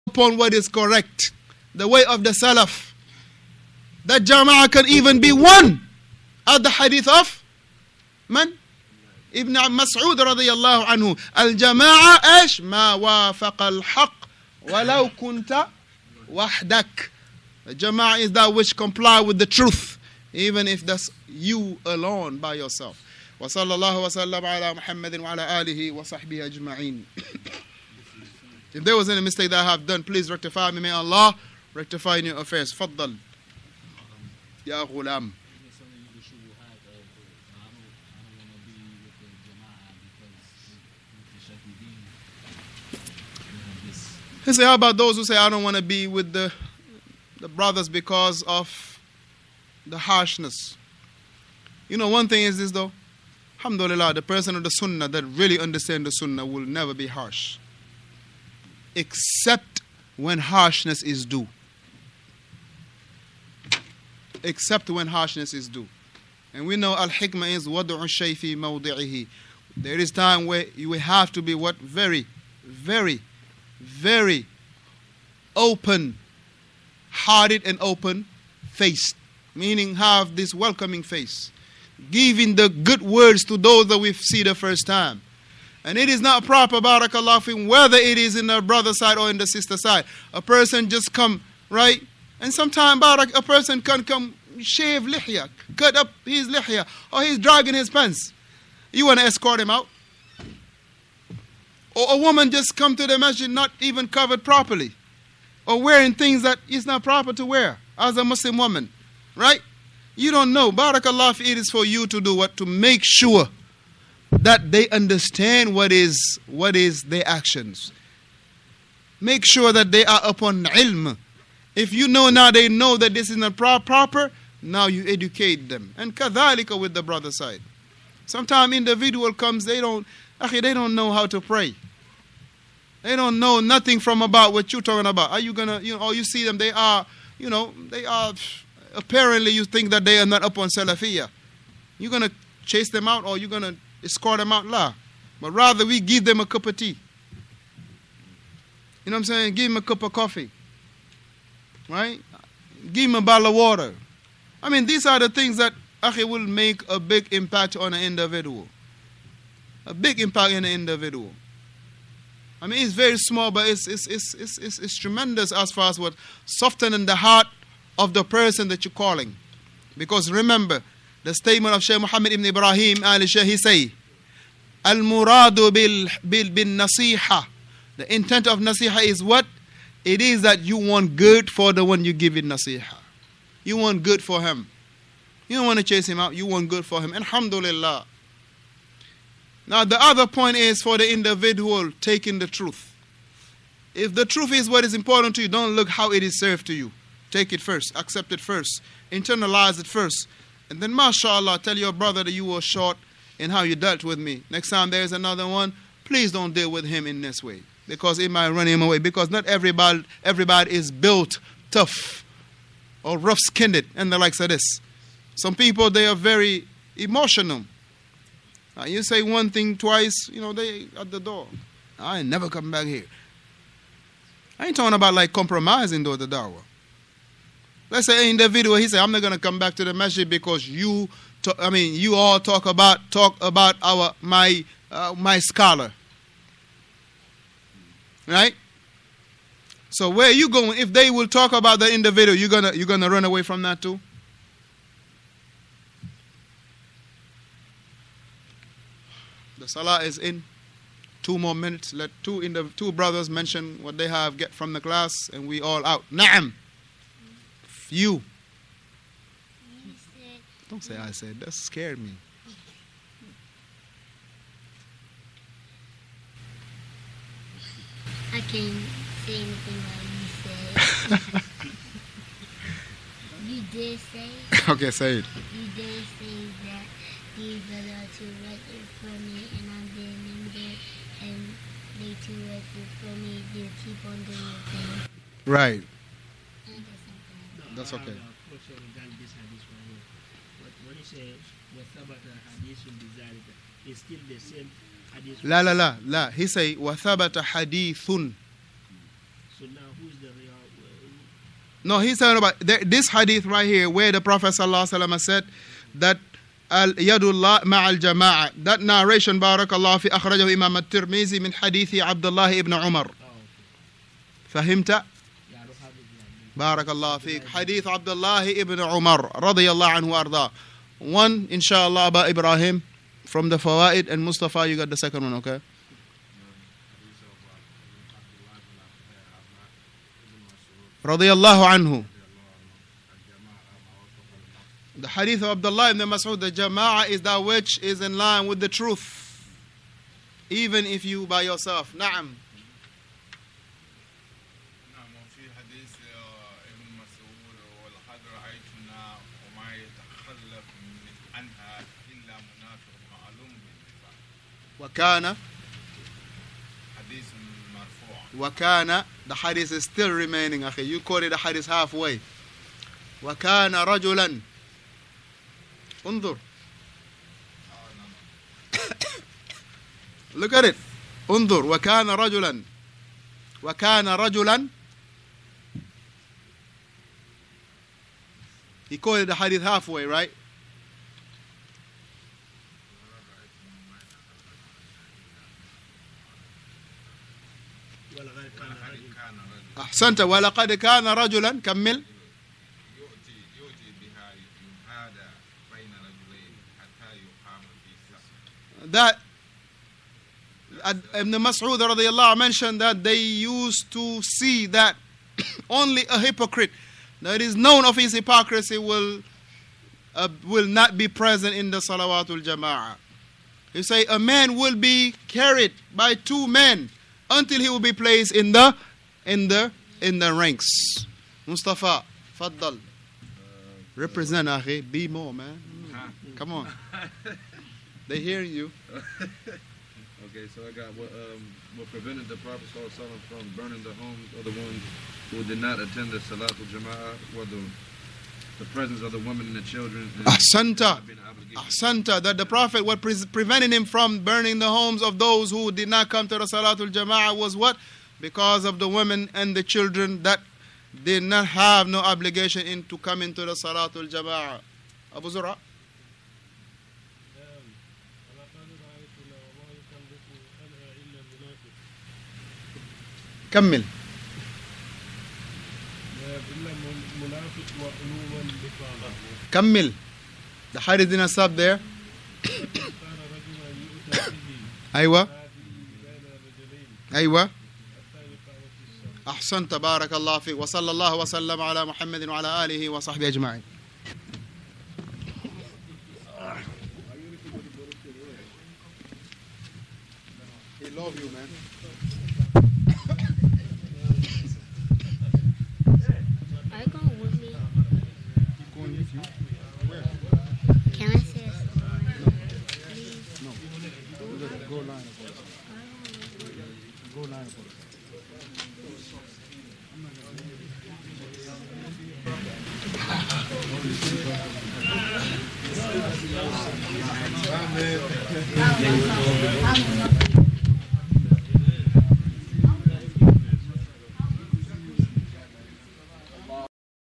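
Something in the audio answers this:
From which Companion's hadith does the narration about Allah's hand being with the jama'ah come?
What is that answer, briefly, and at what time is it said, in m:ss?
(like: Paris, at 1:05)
Abdullah ibn Umar, at 5:12.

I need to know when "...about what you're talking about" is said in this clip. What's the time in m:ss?
2:14.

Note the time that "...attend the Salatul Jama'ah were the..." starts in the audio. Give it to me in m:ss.
7:15.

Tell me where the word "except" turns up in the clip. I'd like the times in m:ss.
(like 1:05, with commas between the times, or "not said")
0:58, 1:04.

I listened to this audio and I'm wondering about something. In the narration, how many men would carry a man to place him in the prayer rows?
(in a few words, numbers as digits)
2.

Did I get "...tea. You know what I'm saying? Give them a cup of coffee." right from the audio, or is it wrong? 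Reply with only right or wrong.
right.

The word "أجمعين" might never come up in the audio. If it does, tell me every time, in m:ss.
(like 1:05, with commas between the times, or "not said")
0:26, 8:03.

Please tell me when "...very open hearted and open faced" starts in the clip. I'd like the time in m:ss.
1:13.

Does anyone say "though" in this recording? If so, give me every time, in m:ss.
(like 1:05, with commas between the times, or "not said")
0:52, 3:46.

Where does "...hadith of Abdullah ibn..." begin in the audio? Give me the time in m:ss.
5:35.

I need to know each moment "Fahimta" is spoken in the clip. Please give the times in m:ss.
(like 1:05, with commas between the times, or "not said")
5:14.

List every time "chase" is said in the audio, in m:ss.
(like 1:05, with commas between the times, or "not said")
2:22, 3:05.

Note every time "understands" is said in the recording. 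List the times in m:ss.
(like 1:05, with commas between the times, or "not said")
0:55, 1:54.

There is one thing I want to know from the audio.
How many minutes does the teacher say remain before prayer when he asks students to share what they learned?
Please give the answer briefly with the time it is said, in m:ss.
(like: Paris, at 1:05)
2, at 4:11.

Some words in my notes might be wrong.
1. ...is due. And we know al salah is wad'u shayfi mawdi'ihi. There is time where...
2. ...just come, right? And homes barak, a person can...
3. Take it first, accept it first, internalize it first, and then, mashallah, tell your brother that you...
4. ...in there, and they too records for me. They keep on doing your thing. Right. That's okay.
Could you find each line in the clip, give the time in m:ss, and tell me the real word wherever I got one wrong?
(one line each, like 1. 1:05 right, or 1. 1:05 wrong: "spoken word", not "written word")
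1. 1:05 wrong: "hikmah", not "salah"
2. 1:30 wrong: "sometimes", not "homes"
3. 3:17 right
4. 4:40 right.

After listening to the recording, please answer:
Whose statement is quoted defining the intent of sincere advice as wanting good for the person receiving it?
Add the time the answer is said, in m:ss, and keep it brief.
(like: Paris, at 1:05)
Shaykh Muhammad ibn Ibrahim al Shaykh, at 2:51.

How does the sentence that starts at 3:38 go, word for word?
Now, you say one thing twice, you know, they at the door.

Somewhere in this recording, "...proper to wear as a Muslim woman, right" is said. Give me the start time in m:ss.
1:47.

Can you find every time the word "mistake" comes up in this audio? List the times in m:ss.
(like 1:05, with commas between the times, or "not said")
0:29.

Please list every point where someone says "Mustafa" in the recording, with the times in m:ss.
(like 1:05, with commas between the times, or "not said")
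5:24, 7:01.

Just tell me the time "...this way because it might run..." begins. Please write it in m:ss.
3:27.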